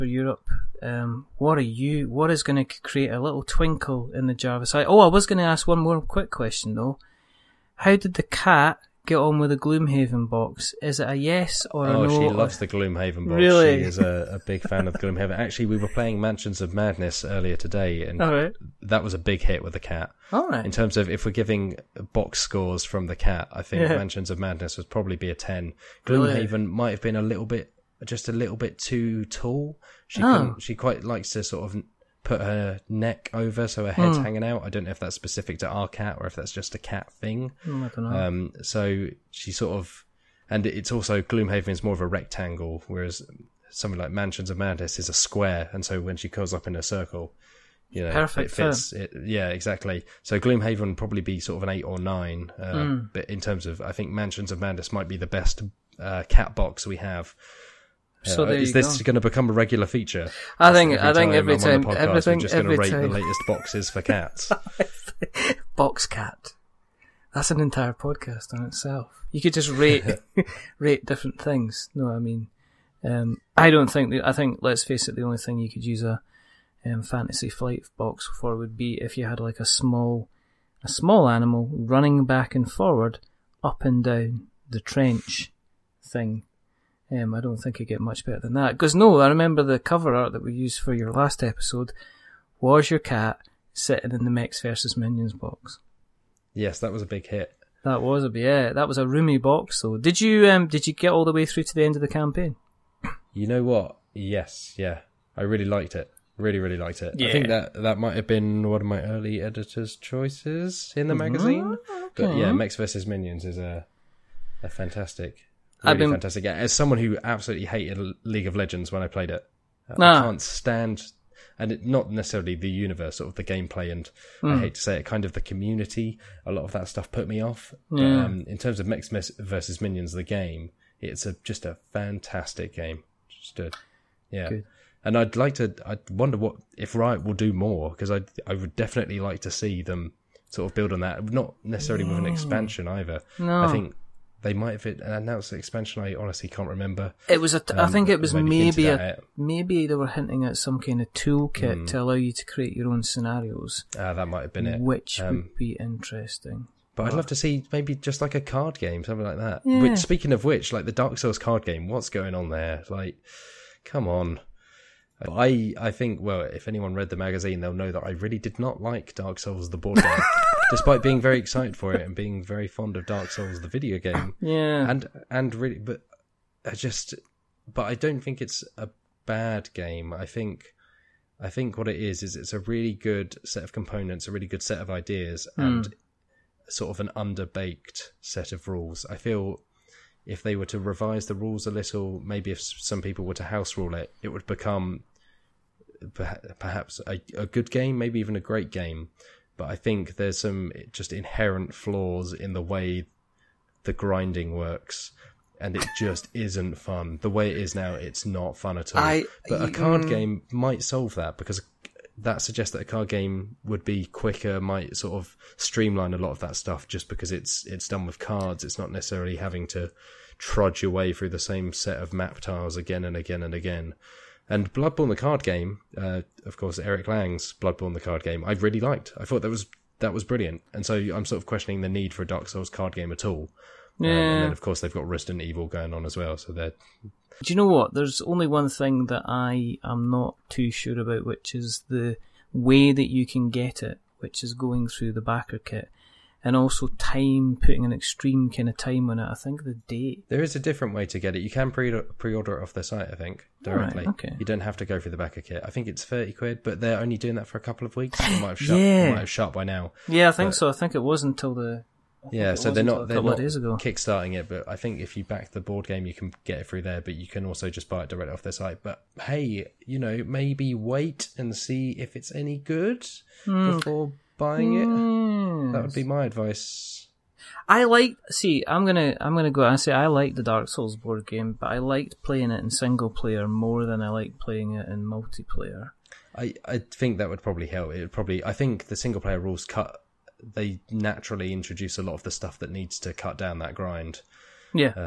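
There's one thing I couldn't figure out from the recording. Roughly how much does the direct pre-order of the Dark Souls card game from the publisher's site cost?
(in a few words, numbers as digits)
£30.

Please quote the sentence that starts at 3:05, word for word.
and sort of an underbaked set of rules.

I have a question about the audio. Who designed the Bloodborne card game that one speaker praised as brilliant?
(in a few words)
Eric Lang.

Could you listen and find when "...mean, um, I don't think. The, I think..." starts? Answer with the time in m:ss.
1:12.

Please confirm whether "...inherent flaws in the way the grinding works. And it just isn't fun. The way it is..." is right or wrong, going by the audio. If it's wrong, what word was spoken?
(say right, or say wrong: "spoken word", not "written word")
right.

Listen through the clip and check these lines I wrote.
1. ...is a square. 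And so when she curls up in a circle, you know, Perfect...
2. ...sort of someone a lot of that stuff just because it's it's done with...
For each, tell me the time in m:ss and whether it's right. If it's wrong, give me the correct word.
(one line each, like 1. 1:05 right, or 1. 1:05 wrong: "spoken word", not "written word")
1. 0:44 right
2. 3:34 wrong: "streamline", not "someone".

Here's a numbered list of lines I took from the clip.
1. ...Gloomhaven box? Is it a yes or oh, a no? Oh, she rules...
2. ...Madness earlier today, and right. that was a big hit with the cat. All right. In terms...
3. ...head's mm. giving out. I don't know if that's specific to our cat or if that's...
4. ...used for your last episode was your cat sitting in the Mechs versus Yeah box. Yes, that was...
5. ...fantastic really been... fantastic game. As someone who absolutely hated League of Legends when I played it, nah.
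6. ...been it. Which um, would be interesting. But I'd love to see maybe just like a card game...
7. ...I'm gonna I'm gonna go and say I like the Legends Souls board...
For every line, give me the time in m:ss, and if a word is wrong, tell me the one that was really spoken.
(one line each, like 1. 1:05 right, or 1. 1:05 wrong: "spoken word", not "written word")
1. 0:09 wrong: "loves", not "rules"
2. 0:16 right
3. 0:33 wrong: "hanging", not "giving"
4. 1:30 wrong: "Minions", not "Yeah"
5. 1:54 right
6. 2:34 right
7. 4:38 wrong: "Dark", not "Legends".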